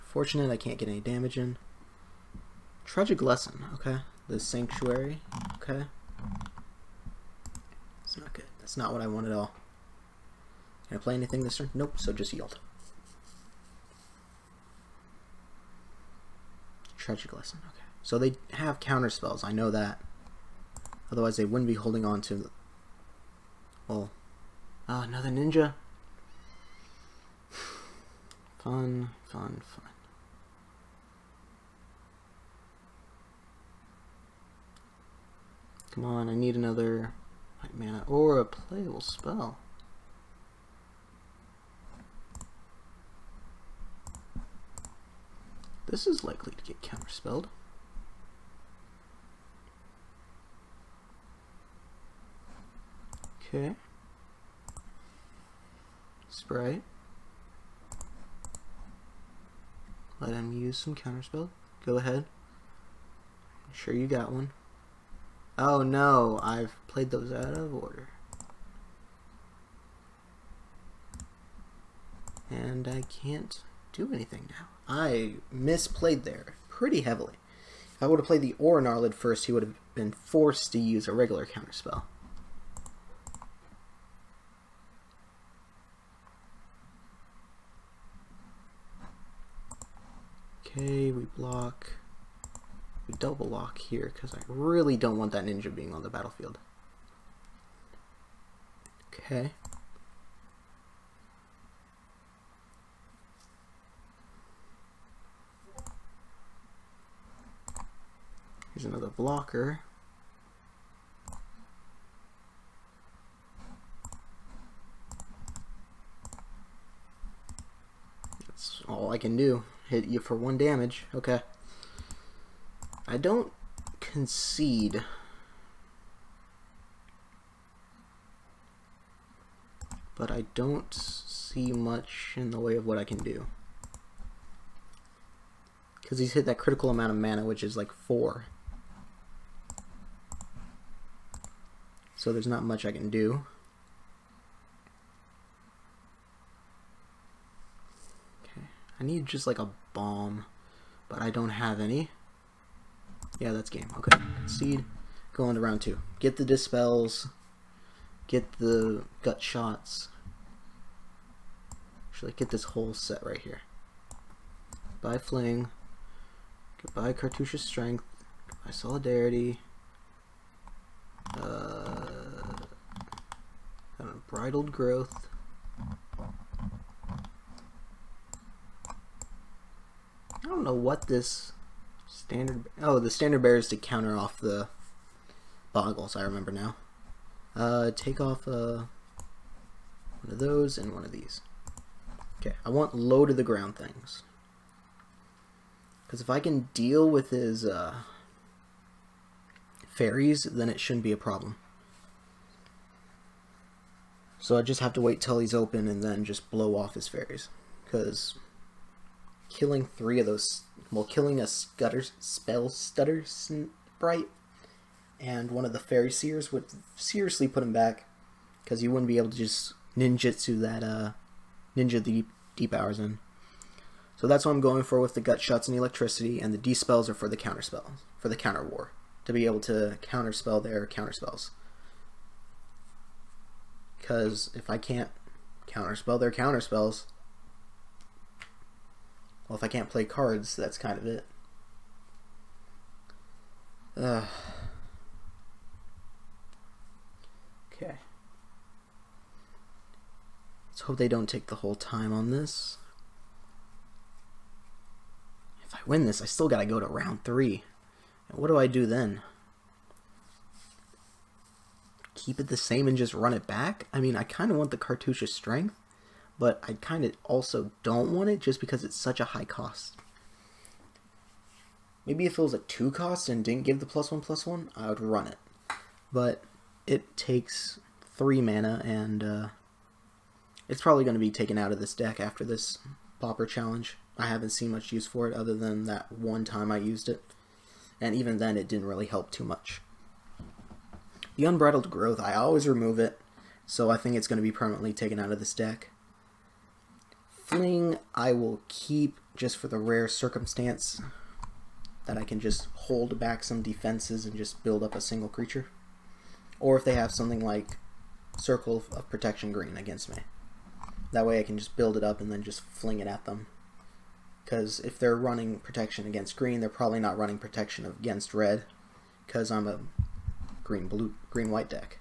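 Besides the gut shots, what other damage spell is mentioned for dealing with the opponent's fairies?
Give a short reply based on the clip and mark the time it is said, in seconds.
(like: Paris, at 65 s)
Electricity, at 225 s.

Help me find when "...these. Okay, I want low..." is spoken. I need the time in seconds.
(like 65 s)
191 s.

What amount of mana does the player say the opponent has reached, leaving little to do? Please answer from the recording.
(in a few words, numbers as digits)
4.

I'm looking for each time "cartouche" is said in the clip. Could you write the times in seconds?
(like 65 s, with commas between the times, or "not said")
167 s, 264 s.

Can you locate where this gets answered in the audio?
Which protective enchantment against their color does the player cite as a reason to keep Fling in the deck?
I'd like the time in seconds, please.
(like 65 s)
308 s.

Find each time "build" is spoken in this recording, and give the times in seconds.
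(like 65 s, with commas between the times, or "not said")
304 s, 311 s.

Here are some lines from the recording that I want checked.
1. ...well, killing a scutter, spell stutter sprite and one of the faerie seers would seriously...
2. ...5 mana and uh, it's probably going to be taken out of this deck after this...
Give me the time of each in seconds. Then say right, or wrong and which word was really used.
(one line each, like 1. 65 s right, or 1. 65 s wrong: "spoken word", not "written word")
1. 210 s right
2. 278 s wrong: "3", not "5".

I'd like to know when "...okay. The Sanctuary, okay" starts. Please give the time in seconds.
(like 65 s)
3 s.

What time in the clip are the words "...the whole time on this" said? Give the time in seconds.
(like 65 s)
251 s.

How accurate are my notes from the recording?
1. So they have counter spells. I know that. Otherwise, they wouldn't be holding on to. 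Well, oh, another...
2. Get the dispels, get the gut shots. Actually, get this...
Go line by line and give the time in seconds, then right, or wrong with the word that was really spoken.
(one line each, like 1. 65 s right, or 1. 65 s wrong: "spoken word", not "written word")
1. 18 s right
2. 156 s right.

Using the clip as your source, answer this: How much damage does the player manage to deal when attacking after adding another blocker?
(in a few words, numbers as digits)
1.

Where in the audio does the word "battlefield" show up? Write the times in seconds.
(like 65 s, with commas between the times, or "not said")
96 s.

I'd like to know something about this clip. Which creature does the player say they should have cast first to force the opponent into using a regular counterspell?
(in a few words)
Aura Gnarlid.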